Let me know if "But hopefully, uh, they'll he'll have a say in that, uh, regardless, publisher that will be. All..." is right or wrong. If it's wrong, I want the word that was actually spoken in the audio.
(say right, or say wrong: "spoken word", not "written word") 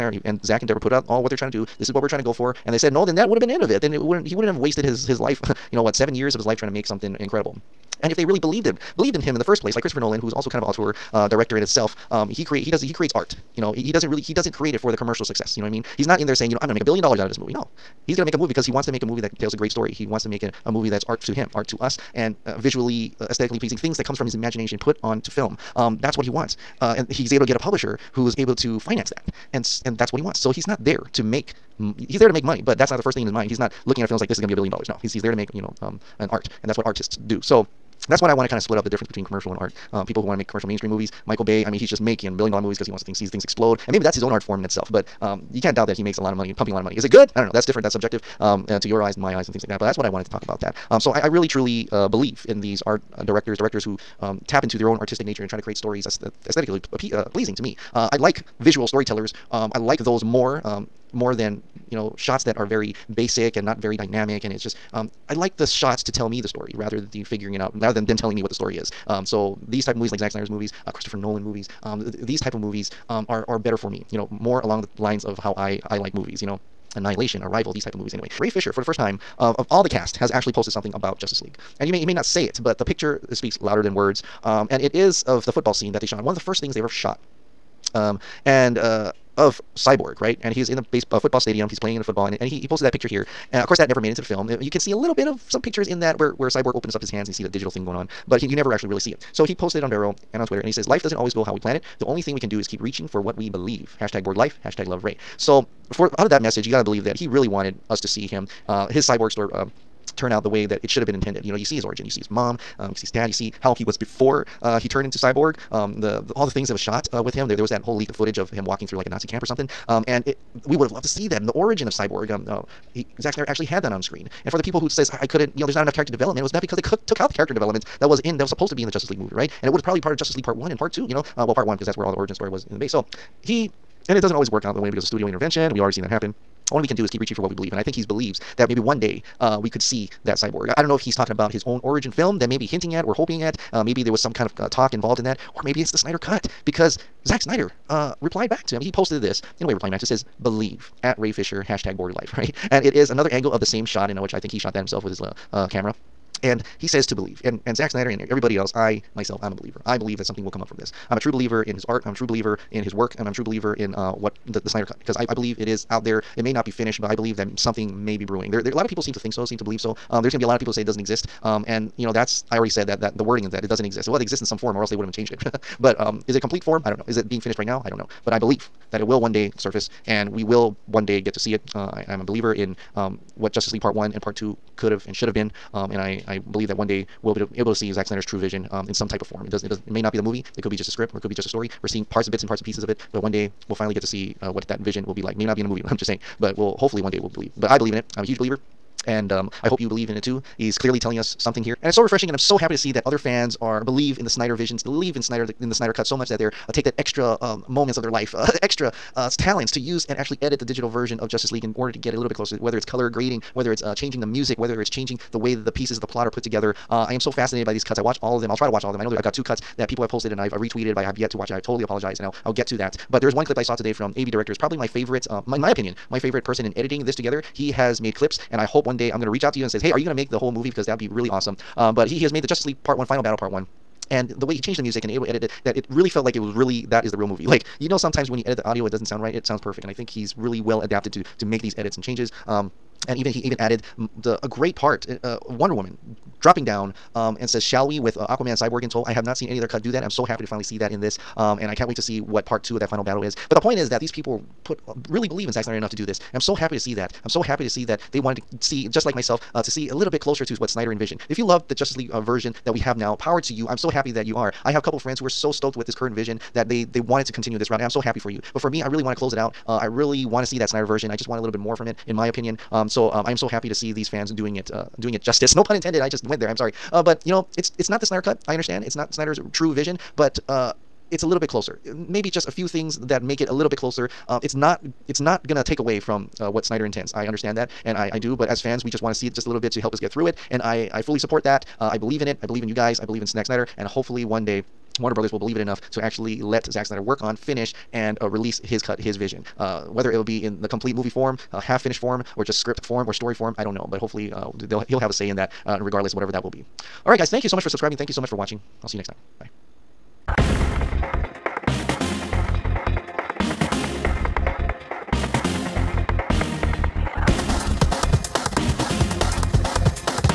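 wrong: "whatever", not "publisher".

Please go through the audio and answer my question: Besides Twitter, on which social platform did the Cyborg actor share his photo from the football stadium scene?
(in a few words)
Vero.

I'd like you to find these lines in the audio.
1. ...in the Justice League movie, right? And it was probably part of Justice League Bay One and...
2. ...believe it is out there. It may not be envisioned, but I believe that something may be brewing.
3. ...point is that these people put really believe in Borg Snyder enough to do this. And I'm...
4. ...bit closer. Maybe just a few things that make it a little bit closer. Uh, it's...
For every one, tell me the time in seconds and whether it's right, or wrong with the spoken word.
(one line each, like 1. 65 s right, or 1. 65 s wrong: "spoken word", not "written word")
1. 128 s wrong: "Part", not "Bay"
2. 165 s wrong: "finished", not "envisioned"
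3. 253 s wrong: "Zack", not "Borg"
4. 281 s right.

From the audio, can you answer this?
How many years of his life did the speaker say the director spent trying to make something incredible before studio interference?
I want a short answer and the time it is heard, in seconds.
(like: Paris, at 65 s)
7, at 5 s.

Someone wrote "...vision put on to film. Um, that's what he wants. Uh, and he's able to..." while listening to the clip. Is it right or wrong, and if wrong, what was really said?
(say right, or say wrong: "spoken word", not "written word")
wrong: "imagination", not "vision".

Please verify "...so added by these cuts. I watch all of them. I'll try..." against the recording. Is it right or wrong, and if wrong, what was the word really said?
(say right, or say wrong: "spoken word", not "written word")
wrong: "fascinated", not "added".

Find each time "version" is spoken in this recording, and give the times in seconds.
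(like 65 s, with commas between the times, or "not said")
210 s, 262 s, 270 s.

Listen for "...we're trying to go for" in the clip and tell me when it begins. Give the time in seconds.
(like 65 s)
2 s.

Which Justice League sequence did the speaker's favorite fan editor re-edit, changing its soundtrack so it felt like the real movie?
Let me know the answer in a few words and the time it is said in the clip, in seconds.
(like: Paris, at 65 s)
Final Battle Part One, at 233 s.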